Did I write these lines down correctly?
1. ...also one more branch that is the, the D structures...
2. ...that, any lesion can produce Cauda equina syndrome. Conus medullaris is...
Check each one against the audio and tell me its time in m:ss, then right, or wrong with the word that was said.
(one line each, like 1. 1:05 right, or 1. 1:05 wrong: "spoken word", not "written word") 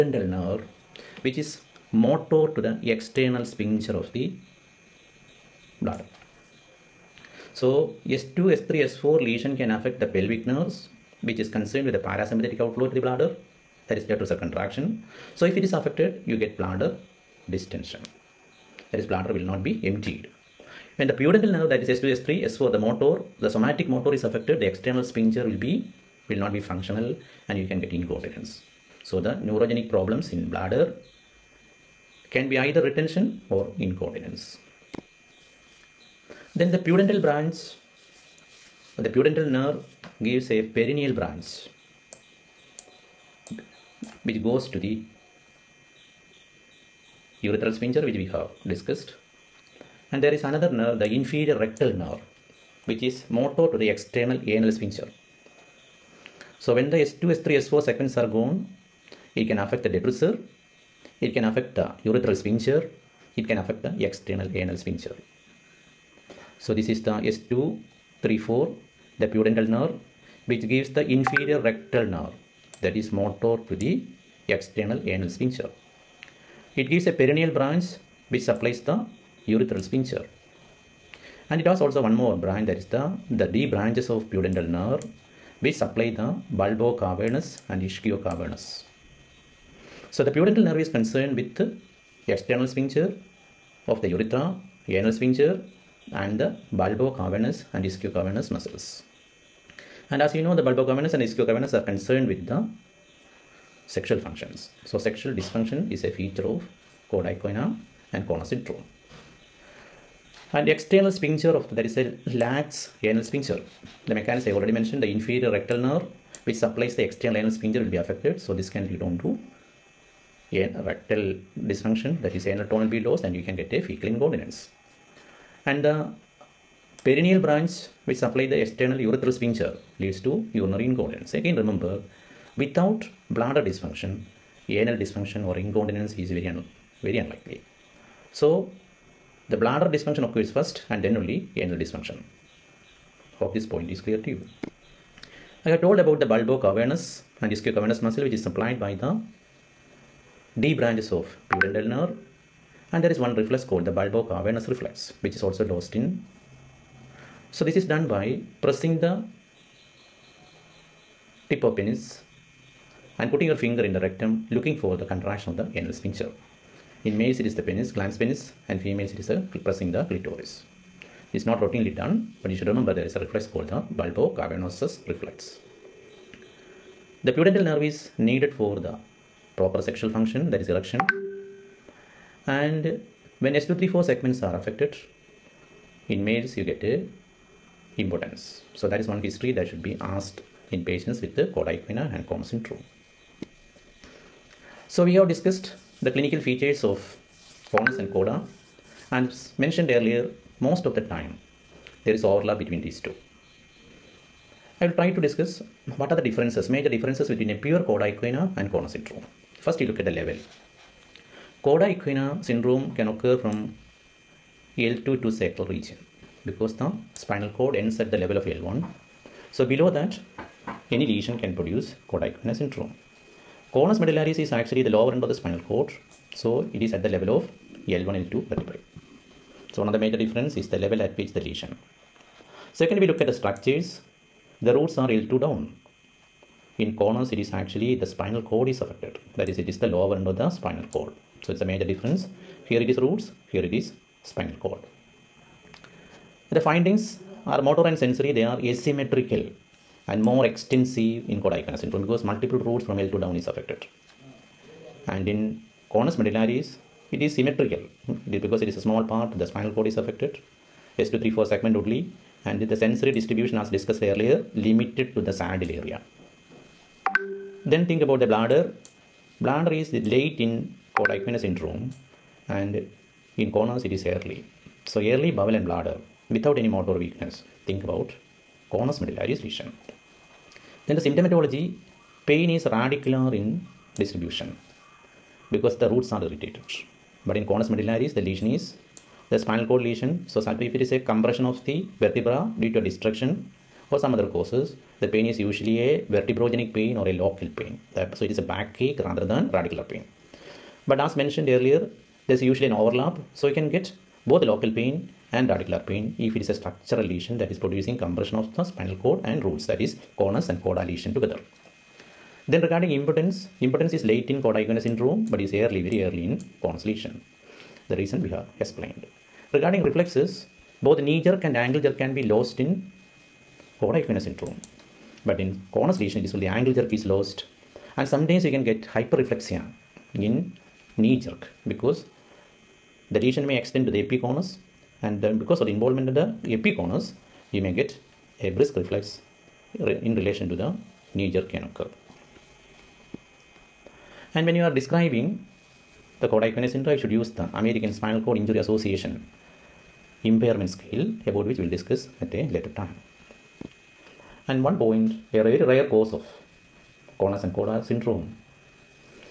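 1. 1:21 wrong: "branches", not "structures"
2. 3:39 right.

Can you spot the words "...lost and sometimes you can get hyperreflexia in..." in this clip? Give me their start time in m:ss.
5:27.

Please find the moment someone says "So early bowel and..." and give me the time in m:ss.
4:34.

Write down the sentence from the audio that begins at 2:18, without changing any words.
So the bladder dysfunction occurs first and then only anal dysfunction.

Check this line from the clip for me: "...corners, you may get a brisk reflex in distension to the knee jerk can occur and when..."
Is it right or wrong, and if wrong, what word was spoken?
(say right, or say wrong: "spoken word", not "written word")
wrong: "relation", not "distension".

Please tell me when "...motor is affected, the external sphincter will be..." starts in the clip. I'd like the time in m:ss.
0:23.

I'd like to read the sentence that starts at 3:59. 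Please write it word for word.
That is, it is the lower end of the spinal cord.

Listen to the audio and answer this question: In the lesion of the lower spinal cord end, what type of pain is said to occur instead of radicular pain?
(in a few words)
Vertebrogenic pain.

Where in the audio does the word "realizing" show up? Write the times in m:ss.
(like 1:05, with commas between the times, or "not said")
not said.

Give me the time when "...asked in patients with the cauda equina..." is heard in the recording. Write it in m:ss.
3:09.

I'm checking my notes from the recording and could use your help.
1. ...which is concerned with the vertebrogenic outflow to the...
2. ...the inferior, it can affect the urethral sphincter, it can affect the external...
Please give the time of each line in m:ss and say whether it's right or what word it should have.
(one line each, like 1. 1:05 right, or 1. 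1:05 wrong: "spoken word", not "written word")
1. 0:11 wrong: "parasympathetic", not "vertebrogenic"
2. 0:59 wrong: "detrusor", not "inferior".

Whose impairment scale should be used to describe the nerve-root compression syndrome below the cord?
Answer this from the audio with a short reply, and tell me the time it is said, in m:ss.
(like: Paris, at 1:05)
American Spinal Cord Injury Association, at 5:47.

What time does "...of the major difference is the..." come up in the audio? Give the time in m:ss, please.
3:49.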